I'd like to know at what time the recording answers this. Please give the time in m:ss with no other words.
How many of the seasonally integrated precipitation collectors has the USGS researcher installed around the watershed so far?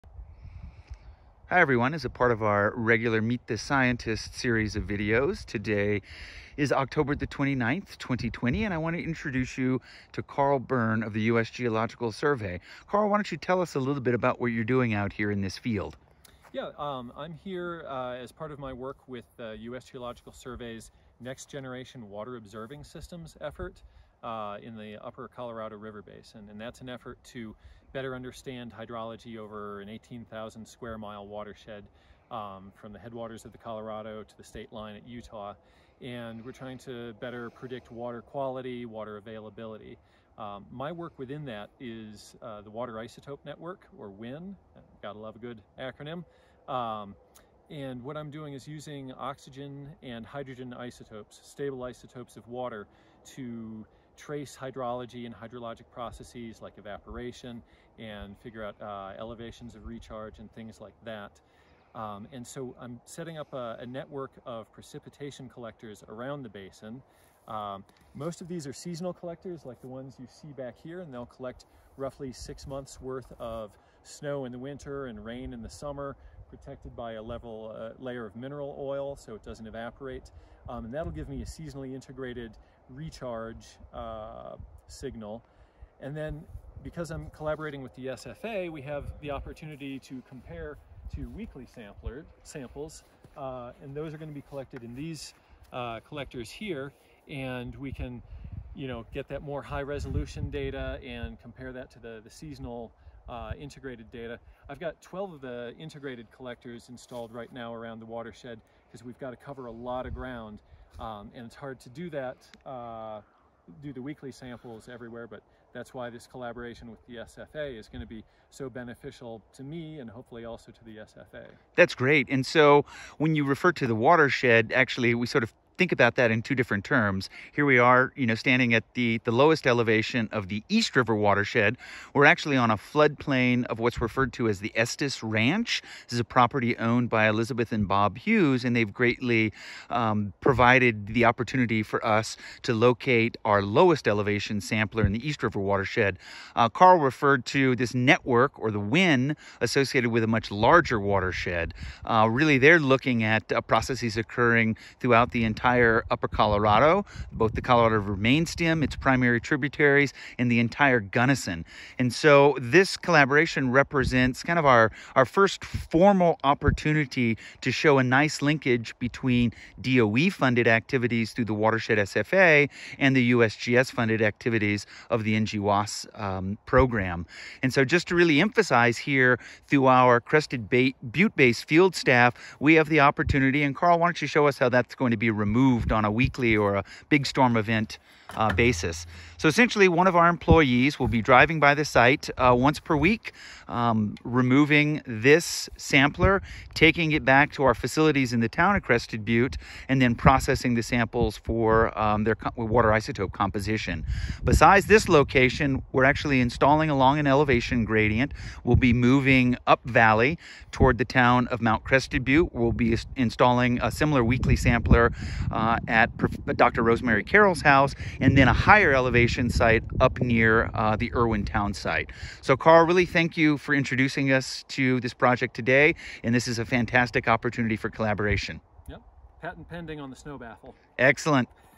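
1:45.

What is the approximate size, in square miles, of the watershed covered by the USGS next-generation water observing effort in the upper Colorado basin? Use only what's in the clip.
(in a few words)
18,000.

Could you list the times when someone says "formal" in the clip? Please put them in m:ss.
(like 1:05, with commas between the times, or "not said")
2:45.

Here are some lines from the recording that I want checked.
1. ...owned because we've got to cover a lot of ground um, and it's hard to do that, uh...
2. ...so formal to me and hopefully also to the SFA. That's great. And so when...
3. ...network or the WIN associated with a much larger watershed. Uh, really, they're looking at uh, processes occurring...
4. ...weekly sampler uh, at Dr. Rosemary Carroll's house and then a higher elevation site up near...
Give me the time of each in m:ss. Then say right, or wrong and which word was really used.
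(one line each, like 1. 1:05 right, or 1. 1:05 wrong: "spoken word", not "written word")
1. 1:48 wrong: "watershed", not "owned"
2. 1:58 wrong: "beneficial", not "formal"
3. 2:27 right
4. 3:34 right.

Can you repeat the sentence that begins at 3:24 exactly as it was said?
Besides this location, we're actually installing along an elevation gradient.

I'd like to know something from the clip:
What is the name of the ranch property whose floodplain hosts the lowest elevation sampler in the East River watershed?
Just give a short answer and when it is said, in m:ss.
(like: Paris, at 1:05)
Estes Ranch, at 2:14.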